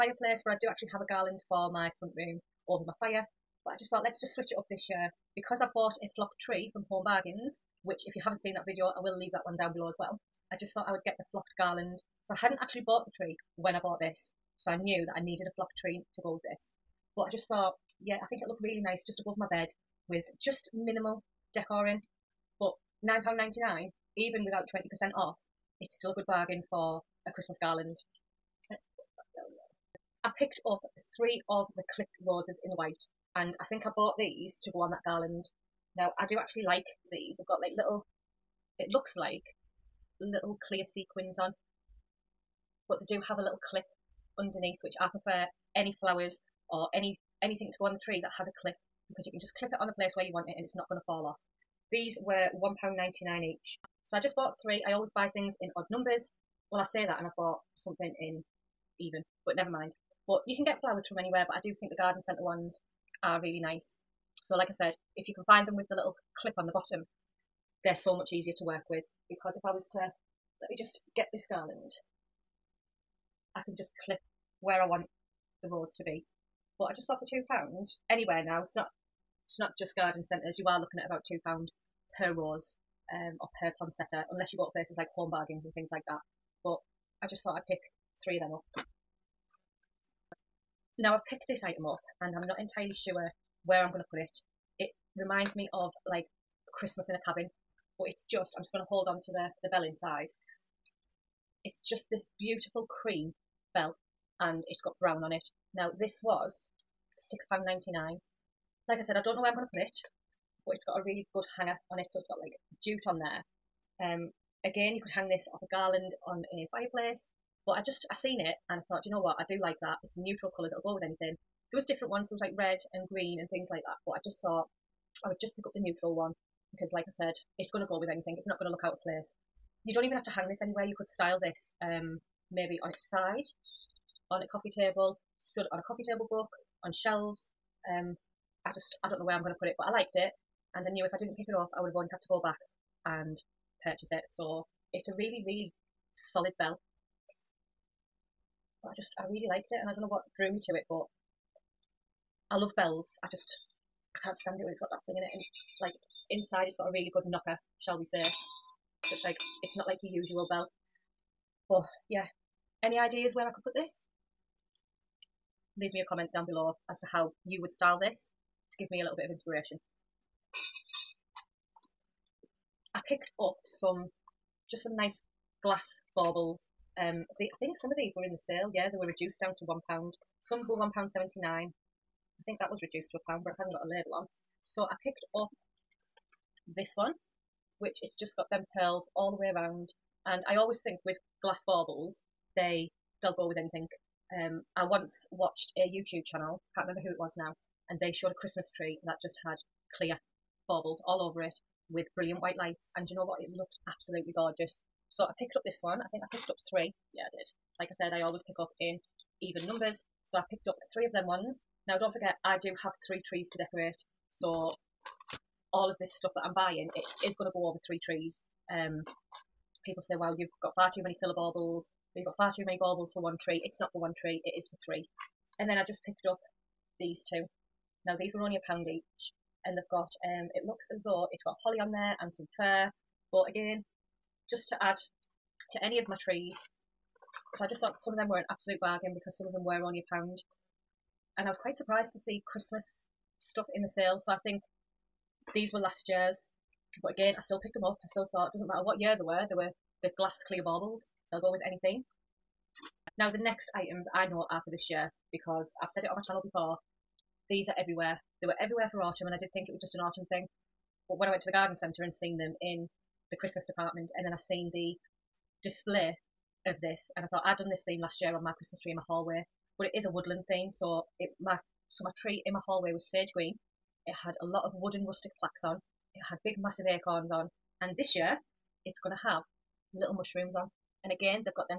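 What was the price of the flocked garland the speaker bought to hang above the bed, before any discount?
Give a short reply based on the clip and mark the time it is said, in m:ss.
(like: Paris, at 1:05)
£9.99, at 0:23.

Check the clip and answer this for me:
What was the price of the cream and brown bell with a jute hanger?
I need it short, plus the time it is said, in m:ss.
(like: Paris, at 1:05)
£6.99, at 1:47.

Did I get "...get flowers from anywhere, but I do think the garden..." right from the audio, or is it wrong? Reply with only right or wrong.
right.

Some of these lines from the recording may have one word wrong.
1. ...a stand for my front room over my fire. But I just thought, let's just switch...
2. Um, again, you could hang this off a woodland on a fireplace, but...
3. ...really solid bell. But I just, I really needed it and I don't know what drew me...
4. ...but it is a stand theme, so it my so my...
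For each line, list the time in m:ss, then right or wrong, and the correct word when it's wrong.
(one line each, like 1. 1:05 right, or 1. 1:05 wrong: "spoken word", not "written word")
1. 0:01 wrong: "garland", not "stand"
2. 1:54 wrong: "garland", not "woodland"
3. 2:25 wrong: "liked", not "needed"
4. 4:29 wrong: "woodland", not "stand".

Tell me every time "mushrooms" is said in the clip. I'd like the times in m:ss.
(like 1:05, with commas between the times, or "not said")
4:40.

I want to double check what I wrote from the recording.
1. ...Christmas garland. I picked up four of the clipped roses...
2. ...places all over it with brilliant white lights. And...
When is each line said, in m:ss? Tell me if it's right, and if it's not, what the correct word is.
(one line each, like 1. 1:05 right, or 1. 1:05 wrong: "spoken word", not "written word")
1. 0:27 wrong: "three", not "four"
2. 3:20 wrong: "baubles", not "places".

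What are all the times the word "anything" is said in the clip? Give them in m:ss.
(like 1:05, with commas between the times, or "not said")
0:47, 2:01, 2:08, 3:13, 4:11.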